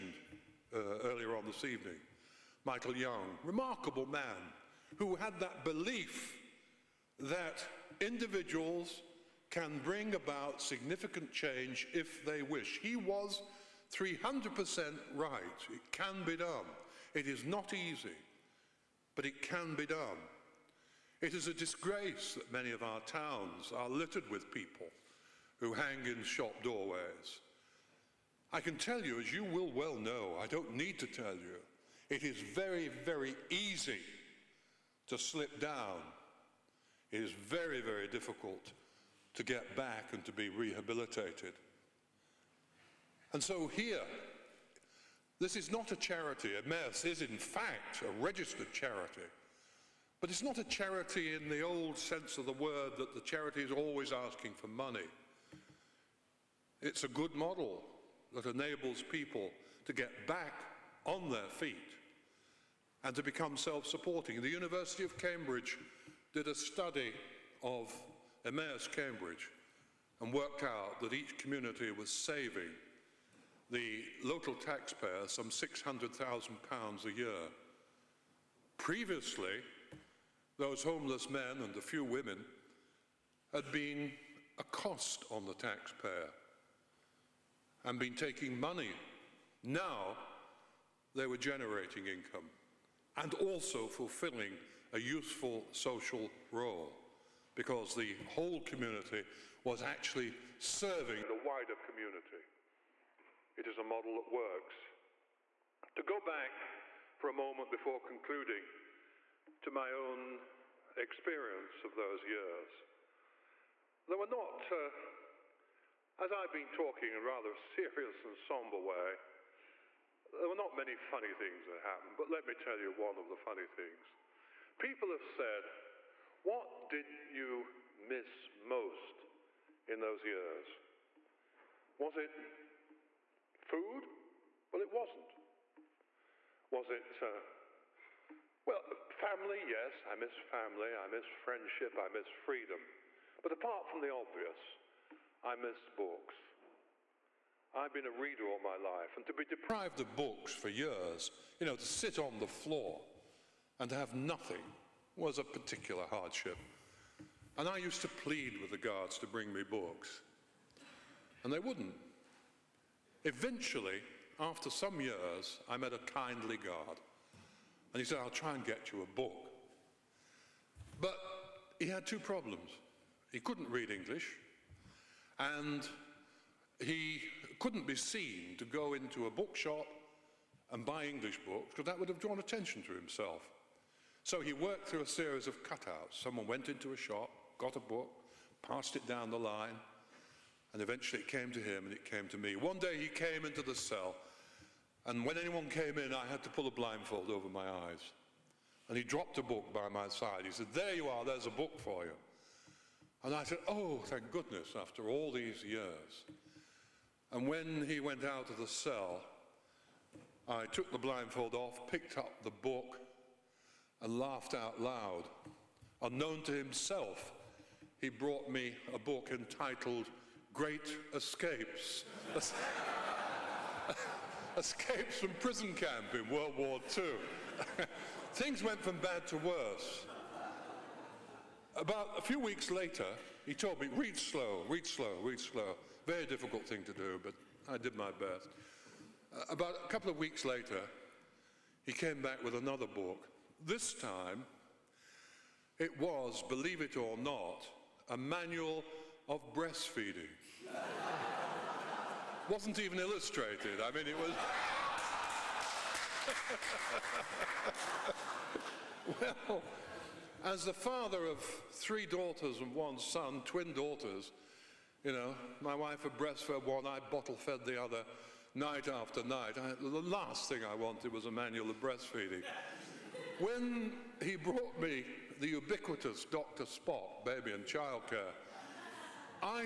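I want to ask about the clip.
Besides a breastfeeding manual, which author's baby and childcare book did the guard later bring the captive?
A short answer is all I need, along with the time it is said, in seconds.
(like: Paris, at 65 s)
Dr. Spock, at 276 s.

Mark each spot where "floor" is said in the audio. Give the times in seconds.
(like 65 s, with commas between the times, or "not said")
152 s.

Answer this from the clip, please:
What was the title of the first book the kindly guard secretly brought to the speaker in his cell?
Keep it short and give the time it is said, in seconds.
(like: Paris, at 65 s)
Great Escapes, at 220 s.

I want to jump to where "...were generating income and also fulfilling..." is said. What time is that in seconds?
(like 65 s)
91 s.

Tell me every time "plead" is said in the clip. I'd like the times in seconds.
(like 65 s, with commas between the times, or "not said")
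158 s.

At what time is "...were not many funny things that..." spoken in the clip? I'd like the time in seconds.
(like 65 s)
120 s.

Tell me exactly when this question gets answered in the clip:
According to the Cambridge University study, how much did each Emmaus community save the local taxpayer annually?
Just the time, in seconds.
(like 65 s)
75 s.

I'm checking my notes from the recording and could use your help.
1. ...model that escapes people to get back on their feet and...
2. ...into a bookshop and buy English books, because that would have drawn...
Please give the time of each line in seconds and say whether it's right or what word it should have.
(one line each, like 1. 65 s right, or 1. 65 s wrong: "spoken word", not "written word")
1. 57 s wrong: "enables", not "escapes"
2. 178 s right.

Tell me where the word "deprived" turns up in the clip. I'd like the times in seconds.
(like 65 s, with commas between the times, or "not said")
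149 s.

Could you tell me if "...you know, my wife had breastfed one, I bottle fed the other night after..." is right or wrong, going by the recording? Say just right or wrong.
right.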